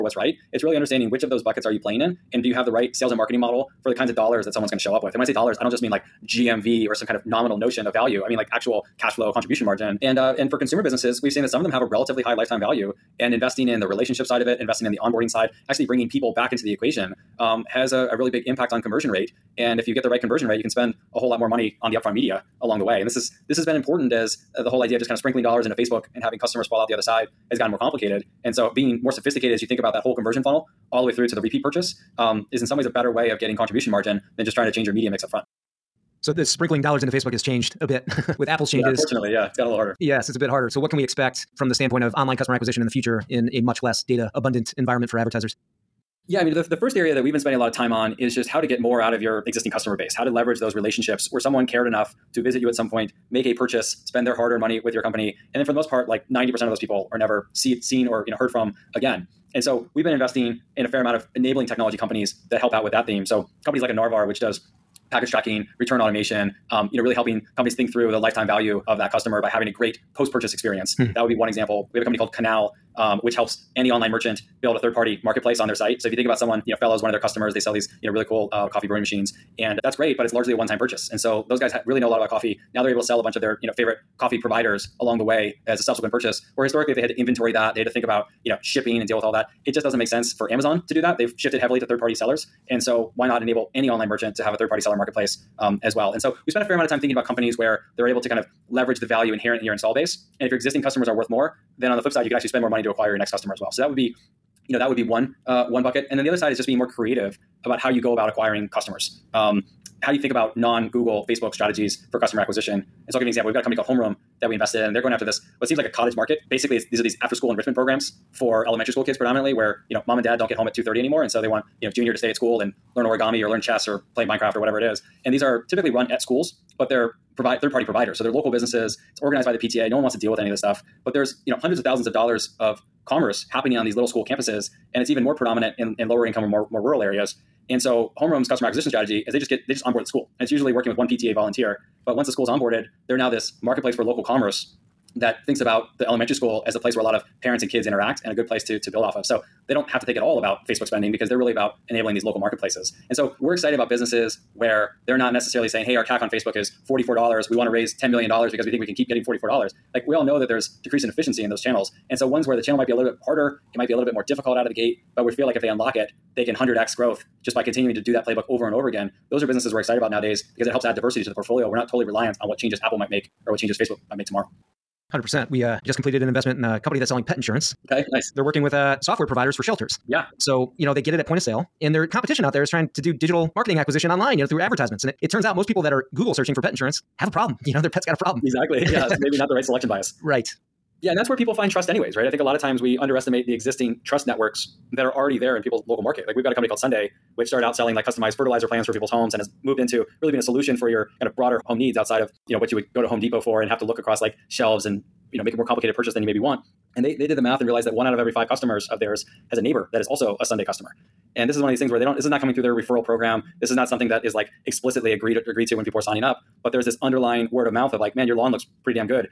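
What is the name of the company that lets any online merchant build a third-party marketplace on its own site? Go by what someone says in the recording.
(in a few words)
Canal.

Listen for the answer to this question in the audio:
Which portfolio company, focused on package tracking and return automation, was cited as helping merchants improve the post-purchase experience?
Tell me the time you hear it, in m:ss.
1:03.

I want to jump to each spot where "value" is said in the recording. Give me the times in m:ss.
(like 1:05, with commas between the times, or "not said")
0:07, 0:12, 1:08, 1:39.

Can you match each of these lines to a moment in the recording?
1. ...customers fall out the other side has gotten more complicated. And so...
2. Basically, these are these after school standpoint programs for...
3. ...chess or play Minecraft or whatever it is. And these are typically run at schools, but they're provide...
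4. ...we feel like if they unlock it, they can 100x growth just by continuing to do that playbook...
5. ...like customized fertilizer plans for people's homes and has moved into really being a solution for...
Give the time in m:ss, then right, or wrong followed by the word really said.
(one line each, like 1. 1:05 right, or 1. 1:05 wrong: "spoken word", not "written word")
1. 0:26 right
2. 1:56 wrong: "enrichment", not "standpoint"
3. 2:03 right
4. 2:45 right
5. 3:17 right.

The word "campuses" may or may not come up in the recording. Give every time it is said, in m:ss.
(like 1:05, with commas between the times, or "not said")
2:14.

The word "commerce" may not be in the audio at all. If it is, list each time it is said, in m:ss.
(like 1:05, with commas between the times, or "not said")
2:13, 2:24.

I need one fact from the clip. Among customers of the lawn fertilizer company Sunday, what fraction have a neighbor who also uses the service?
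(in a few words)
one out of every five.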